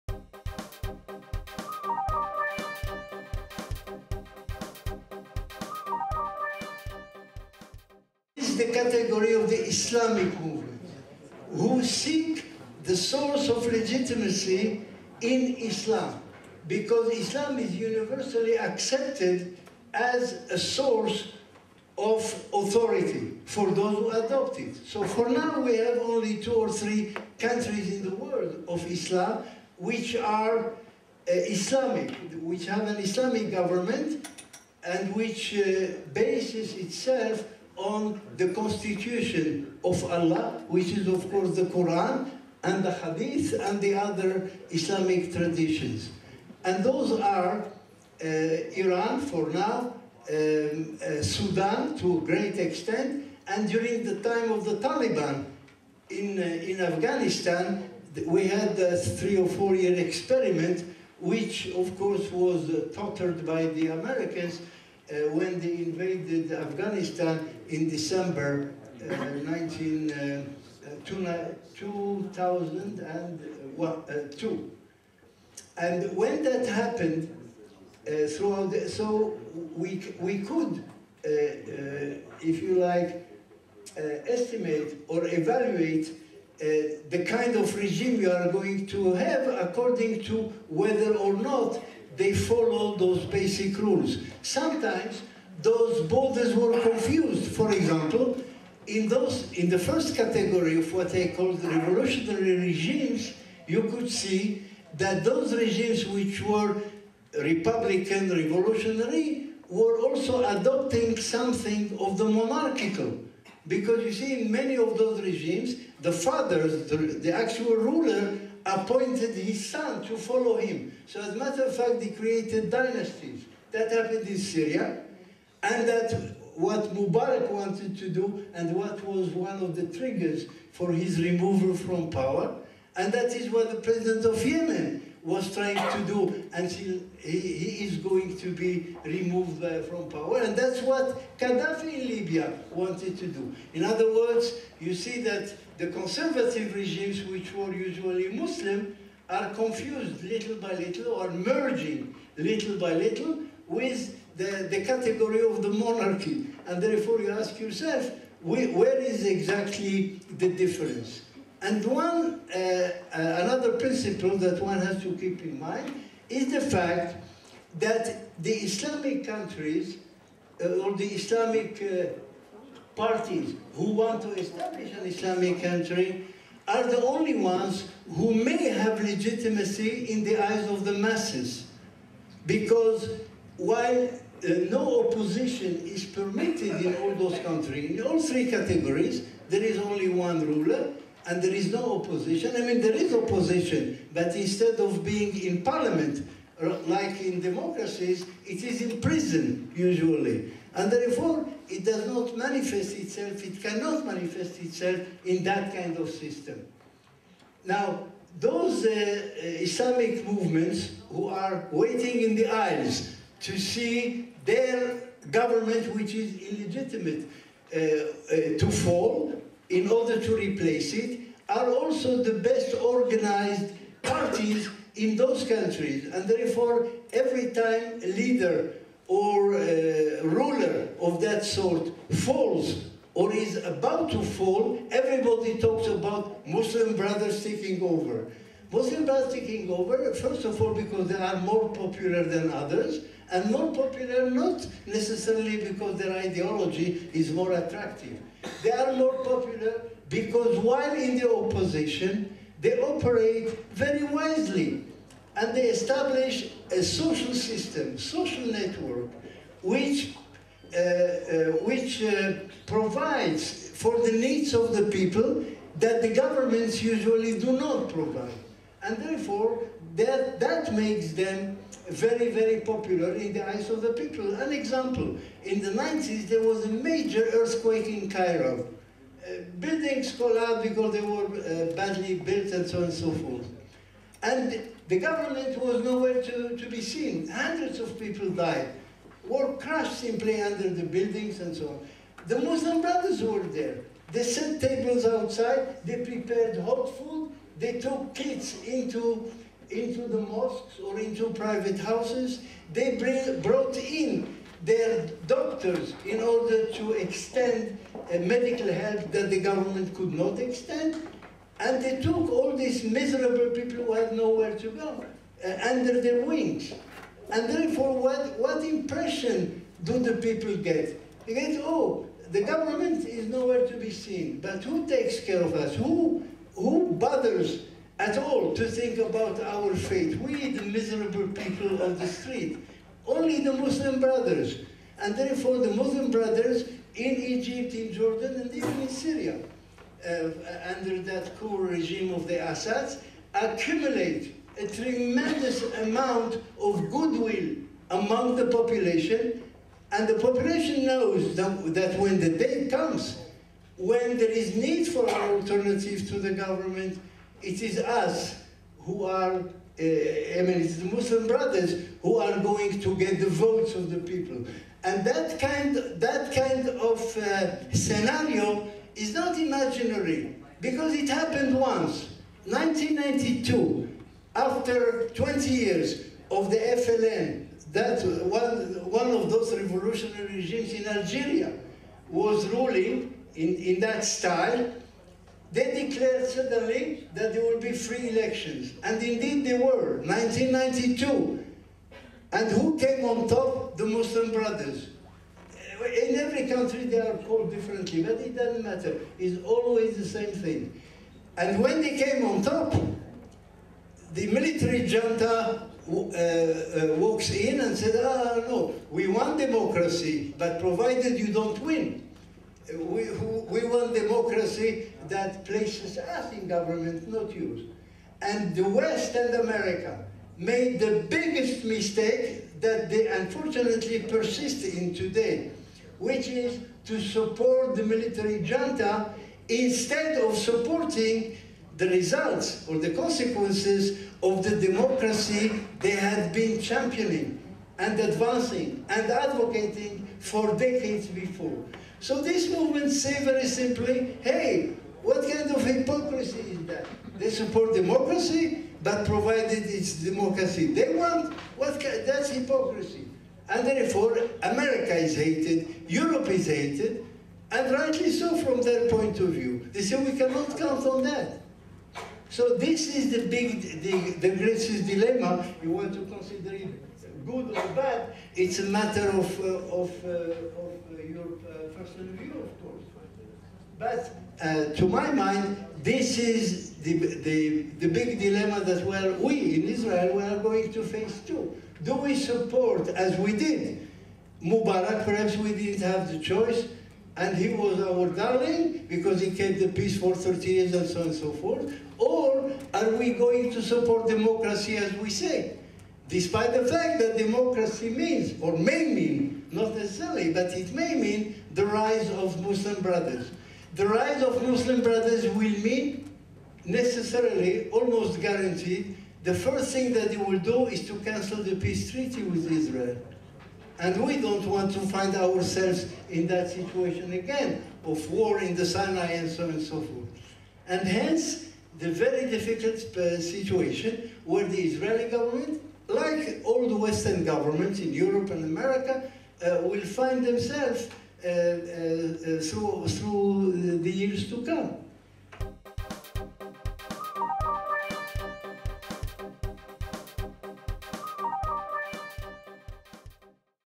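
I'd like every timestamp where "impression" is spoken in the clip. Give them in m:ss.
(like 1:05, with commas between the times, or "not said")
5:18.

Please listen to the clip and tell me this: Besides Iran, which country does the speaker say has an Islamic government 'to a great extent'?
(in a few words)
Sudan.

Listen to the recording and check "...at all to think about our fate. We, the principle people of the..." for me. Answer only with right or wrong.
wrong.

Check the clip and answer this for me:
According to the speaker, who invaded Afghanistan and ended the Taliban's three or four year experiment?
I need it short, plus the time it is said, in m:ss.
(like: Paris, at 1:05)
Americans, at 1:03.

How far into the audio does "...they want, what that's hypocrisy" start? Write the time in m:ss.
7:30.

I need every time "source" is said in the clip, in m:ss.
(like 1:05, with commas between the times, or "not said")
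0:12, 0:20.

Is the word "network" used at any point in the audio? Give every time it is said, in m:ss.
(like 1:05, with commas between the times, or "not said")
4:18.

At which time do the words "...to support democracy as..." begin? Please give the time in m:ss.
8:13.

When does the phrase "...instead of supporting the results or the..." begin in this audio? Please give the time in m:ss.
7:09.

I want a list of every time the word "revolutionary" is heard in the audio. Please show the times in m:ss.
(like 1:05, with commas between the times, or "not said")
1:41, 1:48, 6:19.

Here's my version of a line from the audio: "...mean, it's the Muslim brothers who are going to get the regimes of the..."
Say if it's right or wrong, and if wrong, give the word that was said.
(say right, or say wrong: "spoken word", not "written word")
wrong: "votes", not "regimes".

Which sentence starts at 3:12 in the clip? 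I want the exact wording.
I mean, there is opposition, but instead of being in parliament, uh, like in democracies, it is in prison, usually.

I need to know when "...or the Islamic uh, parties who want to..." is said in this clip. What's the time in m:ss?
2:50.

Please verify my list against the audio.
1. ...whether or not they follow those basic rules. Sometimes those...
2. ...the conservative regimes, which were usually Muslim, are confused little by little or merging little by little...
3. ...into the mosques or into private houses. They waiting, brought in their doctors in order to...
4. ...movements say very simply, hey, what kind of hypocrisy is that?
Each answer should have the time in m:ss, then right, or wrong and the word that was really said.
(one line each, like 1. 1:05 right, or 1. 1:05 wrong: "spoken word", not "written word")
1. 1:30 right
2. 2:25 right
3. 4:59 wrong: "bring", not "waiting"
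4. 7:22 right.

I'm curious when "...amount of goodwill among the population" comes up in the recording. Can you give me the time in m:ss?
5:45.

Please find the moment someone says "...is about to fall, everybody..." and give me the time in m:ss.
3:53.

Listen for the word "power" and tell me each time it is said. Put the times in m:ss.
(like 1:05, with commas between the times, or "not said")
2:12, 2:20.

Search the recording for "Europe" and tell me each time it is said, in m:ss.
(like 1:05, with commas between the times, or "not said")
7:35, 8:47.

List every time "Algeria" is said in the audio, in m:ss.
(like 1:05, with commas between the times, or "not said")
6:20.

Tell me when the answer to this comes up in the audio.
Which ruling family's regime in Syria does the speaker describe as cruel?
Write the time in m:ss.
5:42.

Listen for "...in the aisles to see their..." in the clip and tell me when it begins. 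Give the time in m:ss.
3:32.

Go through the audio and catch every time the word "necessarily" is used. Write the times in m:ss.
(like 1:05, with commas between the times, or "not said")
4:04, 8:19, 8:26.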